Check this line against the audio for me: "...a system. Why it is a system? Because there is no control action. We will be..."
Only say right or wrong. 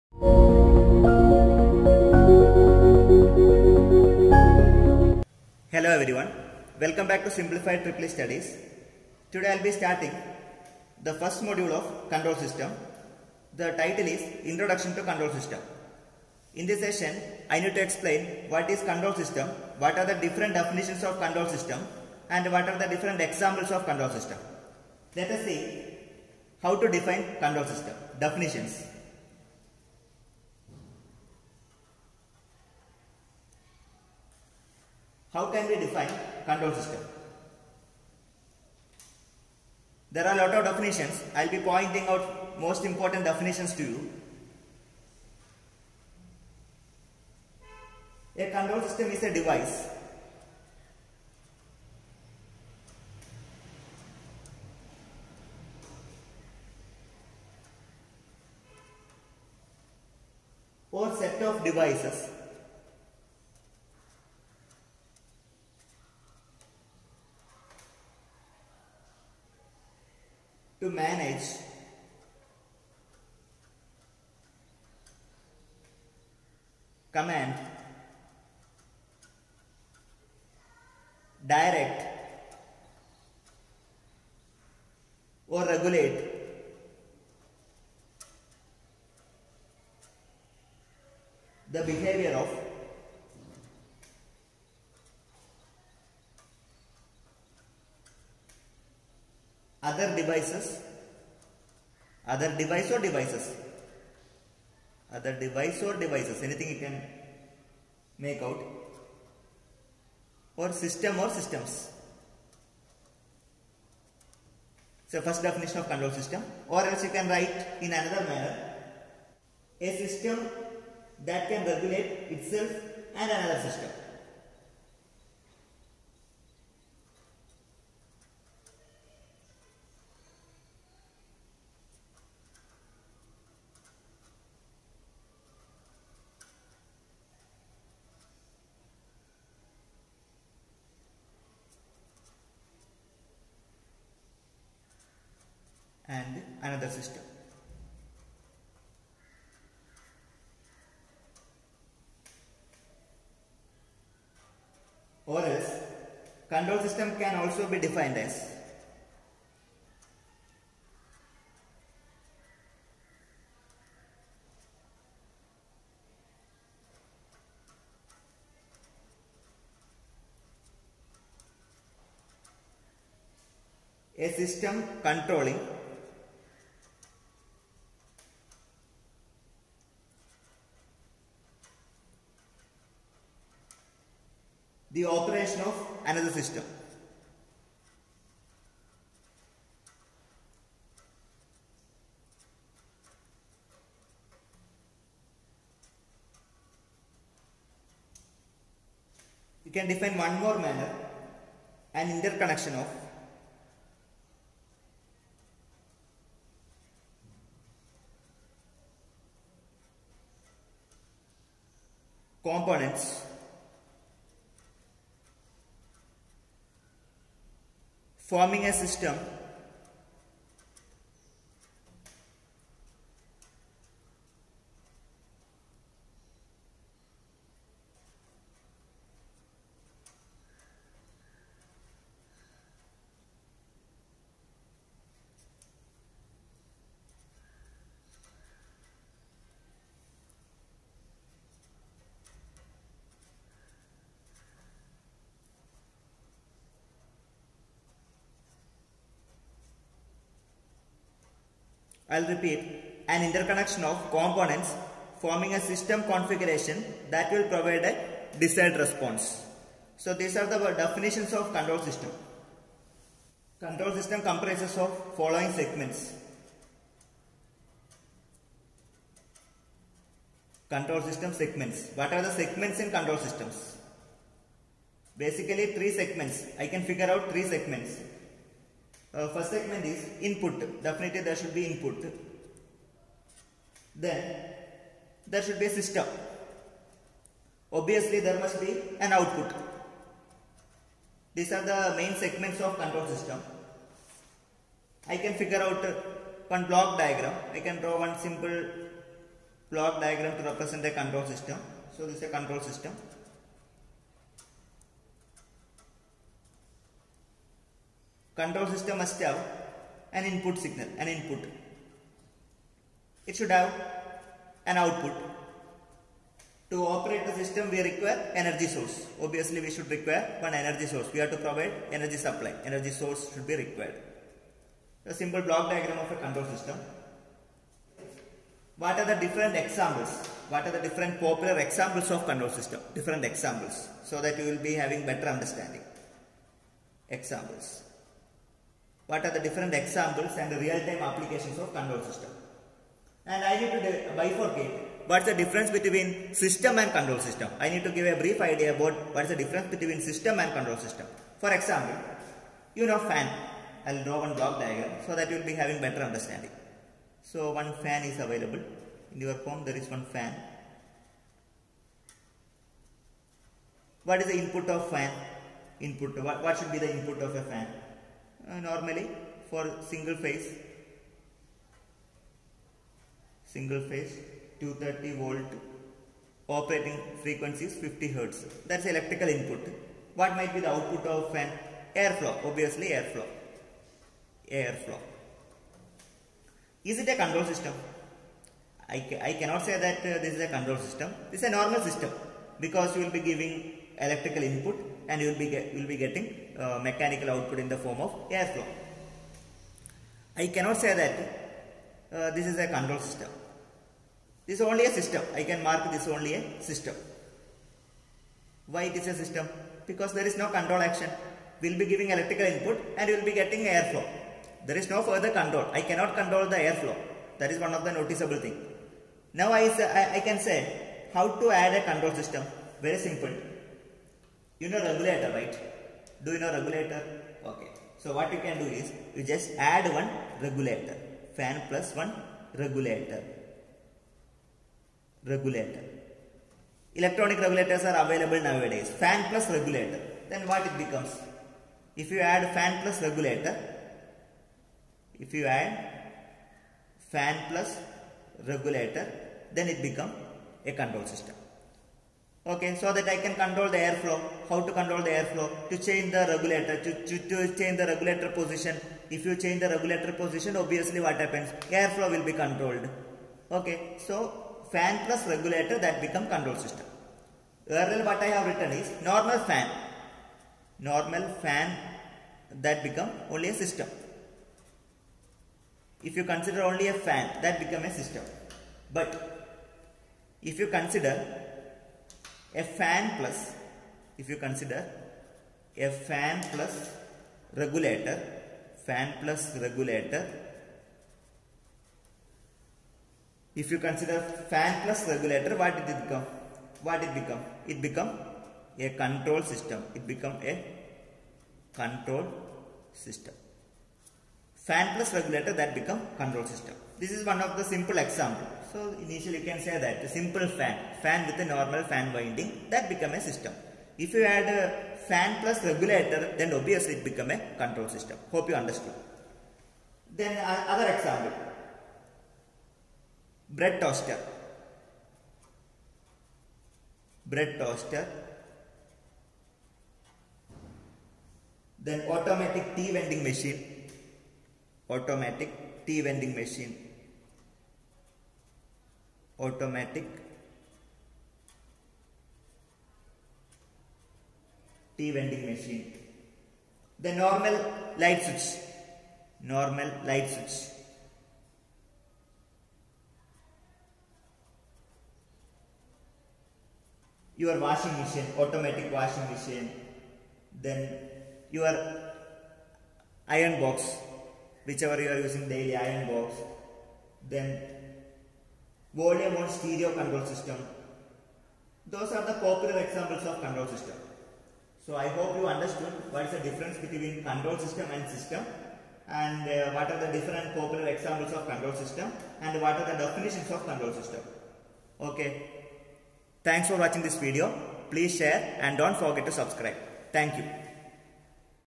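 right.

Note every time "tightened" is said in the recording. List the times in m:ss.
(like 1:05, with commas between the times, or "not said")
not said.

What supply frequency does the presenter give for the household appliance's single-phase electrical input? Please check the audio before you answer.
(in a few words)
50 hertz.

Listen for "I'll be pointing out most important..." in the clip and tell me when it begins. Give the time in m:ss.
0:41.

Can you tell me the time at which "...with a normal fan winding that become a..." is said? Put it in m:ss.
8:31.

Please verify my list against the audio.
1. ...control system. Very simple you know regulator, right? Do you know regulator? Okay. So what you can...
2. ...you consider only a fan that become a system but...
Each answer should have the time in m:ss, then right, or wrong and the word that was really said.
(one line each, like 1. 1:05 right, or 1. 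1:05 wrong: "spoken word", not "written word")
1. 7:01 right
2. 7:56 right.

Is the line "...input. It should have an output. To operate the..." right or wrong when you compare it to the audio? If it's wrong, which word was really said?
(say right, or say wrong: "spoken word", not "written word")
right.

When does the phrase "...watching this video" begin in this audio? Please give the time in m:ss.
9:46.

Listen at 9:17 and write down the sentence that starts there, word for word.
Your washing machine, automatic washing machine.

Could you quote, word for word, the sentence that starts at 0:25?
Let us see how to define control system.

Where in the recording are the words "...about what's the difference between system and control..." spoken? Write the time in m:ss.
5:48.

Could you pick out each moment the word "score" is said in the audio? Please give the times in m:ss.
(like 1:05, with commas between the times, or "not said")
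not said.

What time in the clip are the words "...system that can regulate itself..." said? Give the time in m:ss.
2:00.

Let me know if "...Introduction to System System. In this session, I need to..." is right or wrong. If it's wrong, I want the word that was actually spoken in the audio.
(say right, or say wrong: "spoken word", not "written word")
wrong: "Control", not "System".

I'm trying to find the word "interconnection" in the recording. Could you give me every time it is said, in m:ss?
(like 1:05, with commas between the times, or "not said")
3:22, 4:13.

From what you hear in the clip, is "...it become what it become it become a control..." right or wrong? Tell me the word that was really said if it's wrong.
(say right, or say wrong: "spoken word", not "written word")
right.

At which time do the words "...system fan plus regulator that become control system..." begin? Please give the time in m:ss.
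8:22.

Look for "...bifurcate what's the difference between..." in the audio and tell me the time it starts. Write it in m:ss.
5:44.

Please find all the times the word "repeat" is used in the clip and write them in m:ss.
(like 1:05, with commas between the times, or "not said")
4:12.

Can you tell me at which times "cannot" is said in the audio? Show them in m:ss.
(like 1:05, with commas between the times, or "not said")
6:29, 6:40, 6:55.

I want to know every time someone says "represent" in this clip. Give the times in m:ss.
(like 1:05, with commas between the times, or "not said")
5:00.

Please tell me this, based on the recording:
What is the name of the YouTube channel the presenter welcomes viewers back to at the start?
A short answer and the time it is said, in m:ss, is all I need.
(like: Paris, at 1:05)
Simplified EEE Studies, at 0:07.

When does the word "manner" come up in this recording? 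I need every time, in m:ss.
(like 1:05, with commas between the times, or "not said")
1:58, 3:20.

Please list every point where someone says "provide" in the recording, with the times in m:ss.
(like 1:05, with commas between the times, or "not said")
4:17, 5:21.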